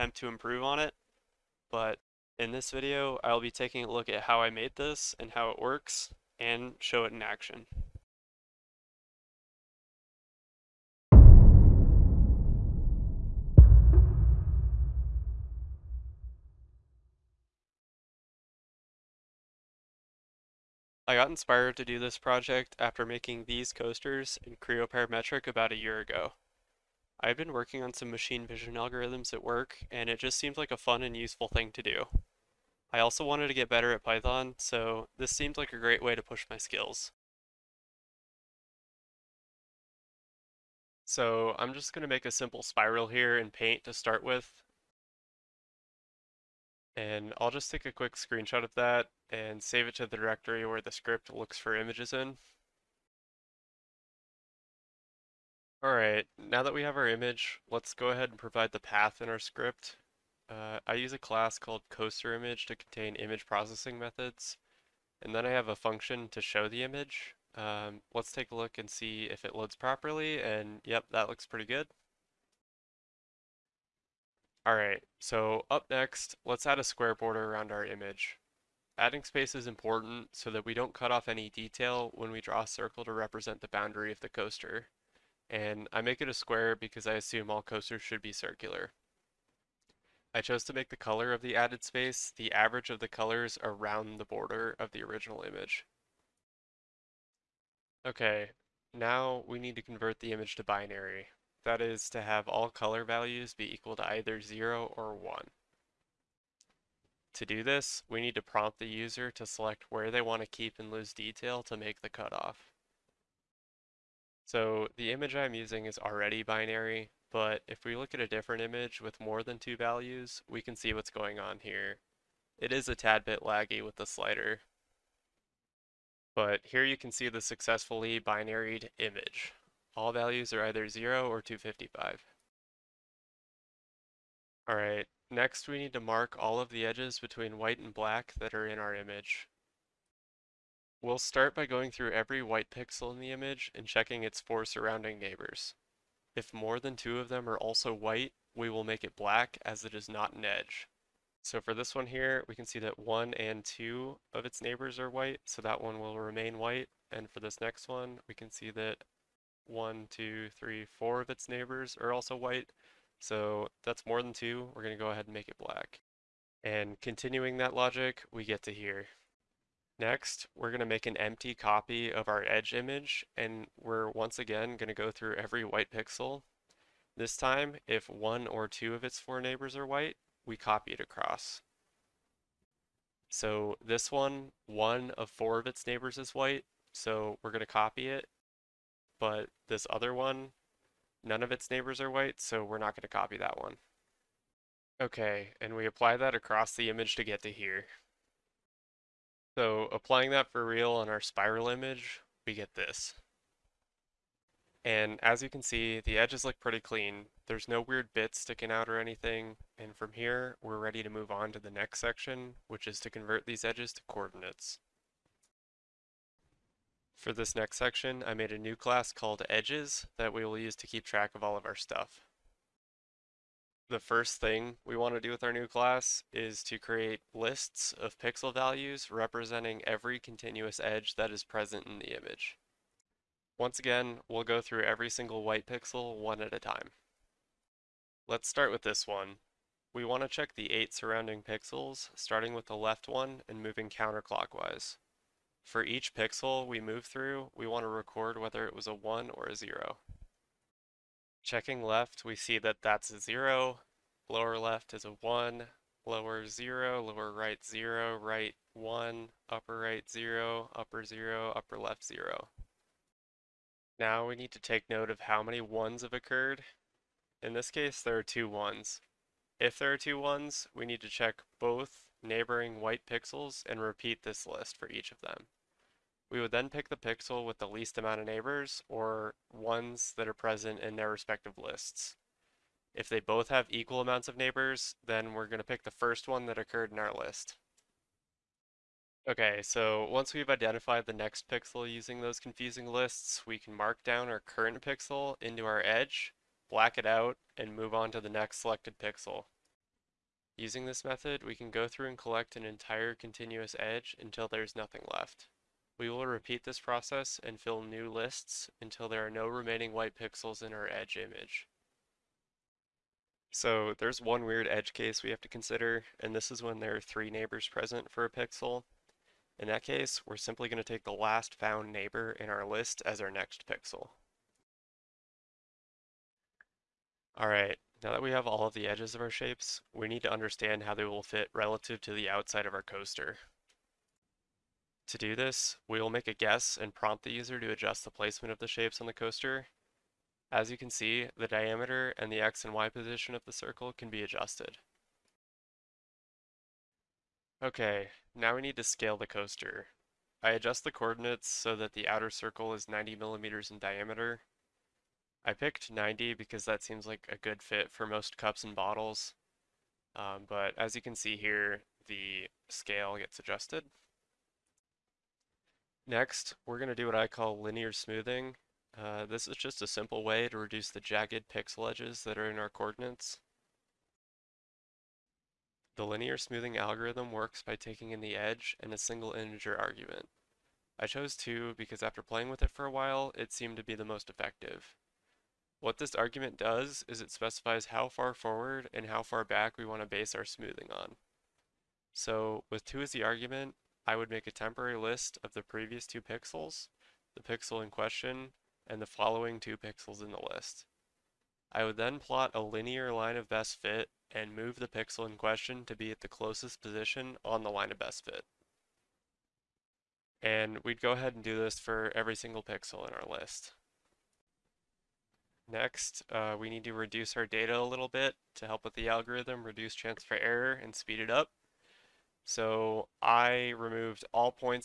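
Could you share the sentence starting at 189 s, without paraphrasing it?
But this other one, none of its neighbors are white, so we're not going to copy that one.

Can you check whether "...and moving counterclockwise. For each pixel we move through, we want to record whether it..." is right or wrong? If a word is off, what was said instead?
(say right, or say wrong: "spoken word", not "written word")
right.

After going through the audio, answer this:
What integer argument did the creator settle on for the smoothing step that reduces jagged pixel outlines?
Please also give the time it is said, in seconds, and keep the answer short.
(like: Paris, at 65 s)
2, at 380 s.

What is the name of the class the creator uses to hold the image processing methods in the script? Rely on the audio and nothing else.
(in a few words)
coaster image.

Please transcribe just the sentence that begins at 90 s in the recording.
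I chose to make the color of the added space the average of the colors around the border of the original image.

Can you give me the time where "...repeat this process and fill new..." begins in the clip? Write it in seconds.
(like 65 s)
306 s.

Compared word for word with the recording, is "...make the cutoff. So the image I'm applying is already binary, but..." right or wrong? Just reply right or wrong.
wrong.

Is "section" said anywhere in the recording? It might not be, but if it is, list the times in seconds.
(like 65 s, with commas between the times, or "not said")
211 s, 217 s.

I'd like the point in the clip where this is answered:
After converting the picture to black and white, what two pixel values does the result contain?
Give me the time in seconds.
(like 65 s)
130 s.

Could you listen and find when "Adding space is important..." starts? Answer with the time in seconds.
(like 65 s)
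78 s.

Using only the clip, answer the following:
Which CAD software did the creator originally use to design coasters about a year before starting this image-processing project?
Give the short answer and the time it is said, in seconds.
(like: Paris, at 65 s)
Creo Parametric, at 24 s.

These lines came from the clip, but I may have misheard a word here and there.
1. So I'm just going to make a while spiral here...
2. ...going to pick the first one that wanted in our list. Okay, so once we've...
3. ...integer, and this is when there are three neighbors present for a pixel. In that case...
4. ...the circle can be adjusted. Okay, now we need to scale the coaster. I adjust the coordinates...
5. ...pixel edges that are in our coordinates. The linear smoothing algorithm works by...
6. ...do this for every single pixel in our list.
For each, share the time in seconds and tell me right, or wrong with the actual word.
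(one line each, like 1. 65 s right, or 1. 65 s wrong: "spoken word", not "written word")
1. 41 s wrong: "simple", not "while"
2. 285 s wrong: "occurred", not "wanted"
3. 315 s wrong: "consider", not "integer"
4. 343 s right
5. 371 s right
6. 411 s right.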